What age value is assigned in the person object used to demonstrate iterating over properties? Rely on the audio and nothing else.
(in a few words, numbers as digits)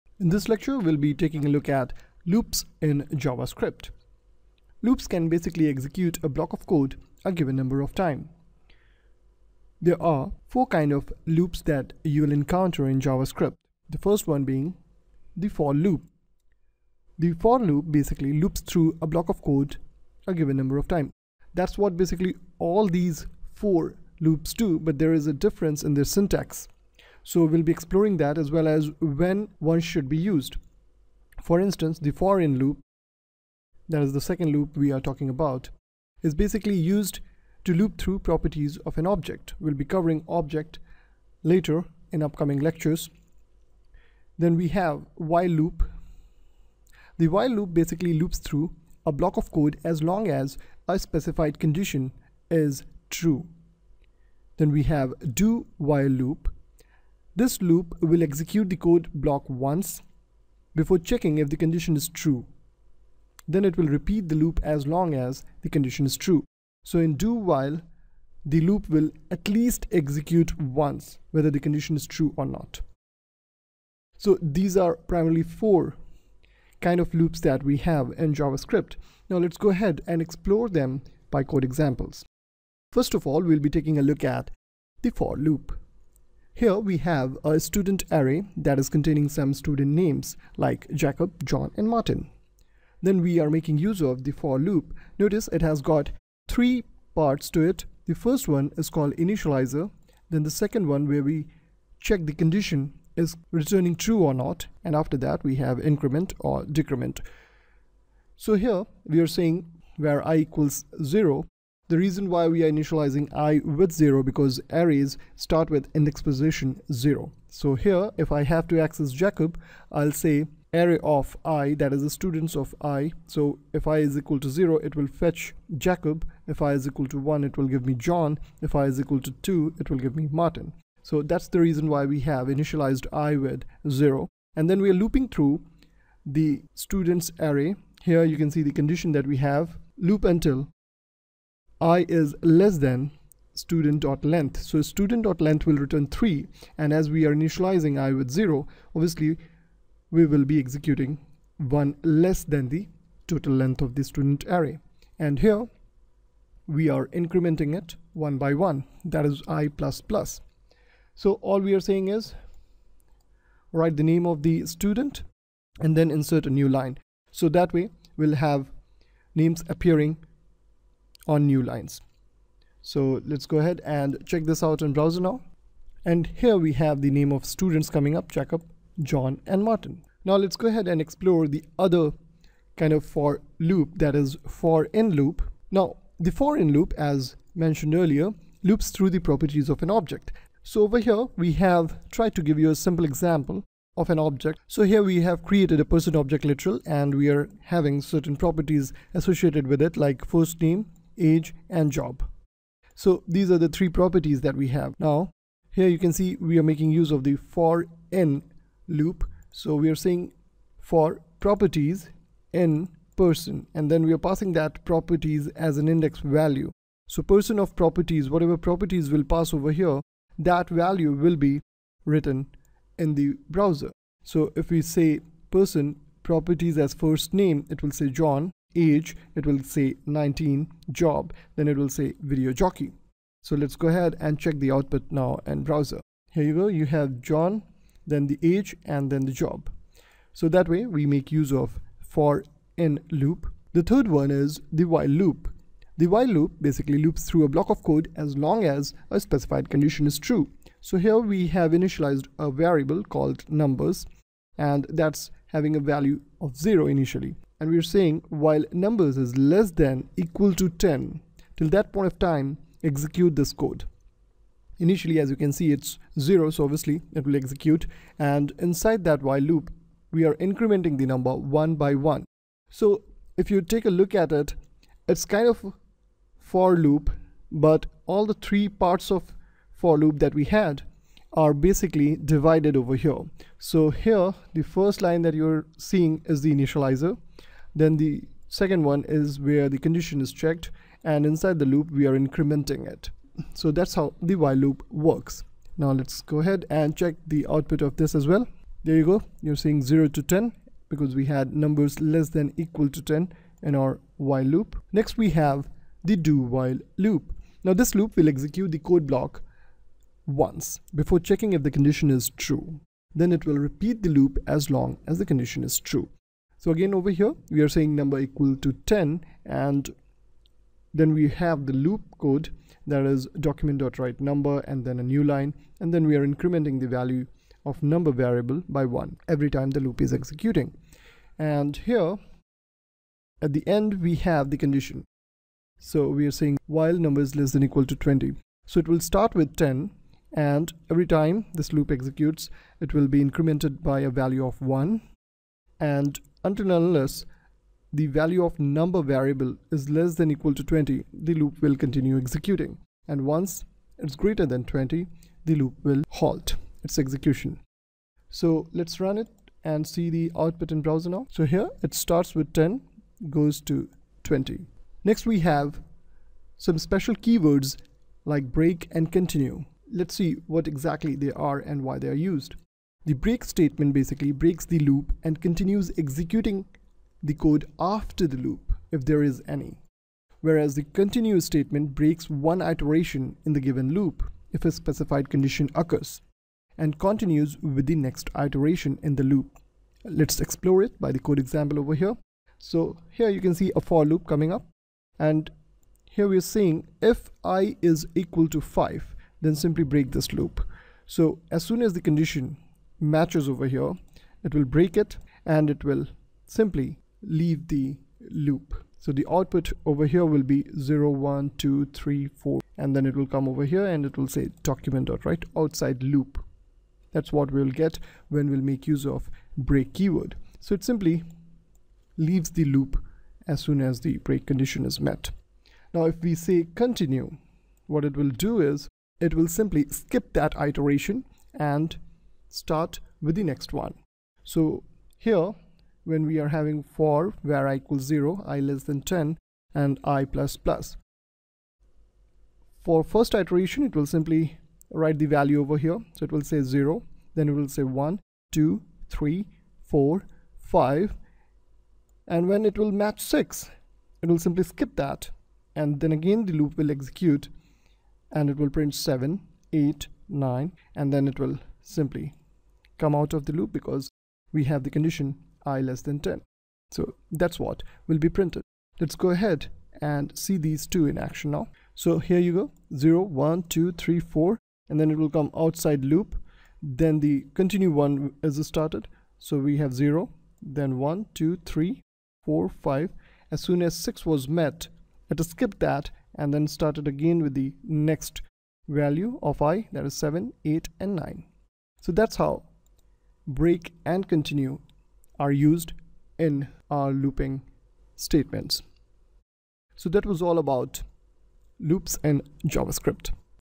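19.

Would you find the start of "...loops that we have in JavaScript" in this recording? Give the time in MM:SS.
01:17.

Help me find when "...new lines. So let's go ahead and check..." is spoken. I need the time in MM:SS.
02:51.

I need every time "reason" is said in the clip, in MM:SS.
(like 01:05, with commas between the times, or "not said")
01:51, 02:11.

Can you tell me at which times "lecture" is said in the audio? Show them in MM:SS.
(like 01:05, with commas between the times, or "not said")
00:00, 00:42.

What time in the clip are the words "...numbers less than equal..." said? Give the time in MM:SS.
05:01.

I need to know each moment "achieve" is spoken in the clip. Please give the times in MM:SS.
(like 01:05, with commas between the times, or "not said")
not said.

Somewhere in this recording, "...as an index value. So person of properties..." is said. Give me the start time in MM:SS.
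03:35.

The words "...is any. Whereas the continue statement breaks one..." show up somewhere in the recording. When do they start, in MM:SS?
06:19.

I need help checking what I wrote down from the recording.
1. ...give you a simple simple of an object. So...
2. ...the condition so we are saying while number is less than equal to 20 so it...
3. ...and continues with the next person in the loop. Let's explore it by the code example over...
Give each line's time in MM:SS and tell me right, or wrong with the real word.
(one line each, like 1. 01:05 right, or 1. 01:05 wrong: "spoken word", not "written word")
1. 03:12 wrong: "example", not "simple"
2. 05:34 right
3. 06:26 wrong: "iteration", not "person".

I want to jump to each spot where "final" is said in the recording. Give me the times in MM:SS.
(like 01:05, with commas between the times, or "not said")
not said.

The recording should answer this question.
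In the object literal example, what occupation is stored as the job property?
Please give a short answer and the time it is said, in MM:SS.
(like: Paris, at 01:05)
video jockey, at 03:52.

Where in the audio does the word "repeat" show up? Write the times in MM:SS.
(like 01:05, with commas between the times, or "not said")
01:03, 05:13.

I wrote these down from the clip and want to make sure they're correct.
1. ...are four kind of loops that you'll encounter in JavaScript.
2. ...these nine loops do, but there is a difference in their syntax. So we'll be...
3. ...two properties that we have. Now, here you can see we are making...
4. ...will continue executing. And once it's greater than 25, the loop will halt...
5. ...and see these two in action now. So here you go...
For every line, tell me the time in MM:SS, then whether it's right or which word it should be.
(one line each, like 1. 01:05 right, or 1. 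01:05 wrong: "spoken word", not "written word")
1. 00:09 right
2. 00:22 wrong: "four", not "nine"
3. 03:23 wrong: "three", not "two"
4. 05:51 wrong: "20", not "25"
5. 07:50 right.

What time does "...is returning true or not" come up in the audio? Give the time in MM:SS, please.
01:43.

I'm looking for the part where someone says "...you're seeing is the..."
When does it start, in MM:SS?
04:45.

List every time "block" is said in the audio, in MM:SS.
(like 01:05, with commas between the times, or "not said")
00:06, 00:19, 00:49, 00:59, 04:07, 05:09.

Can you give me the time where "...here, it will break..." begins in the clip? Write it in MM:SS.
06:43.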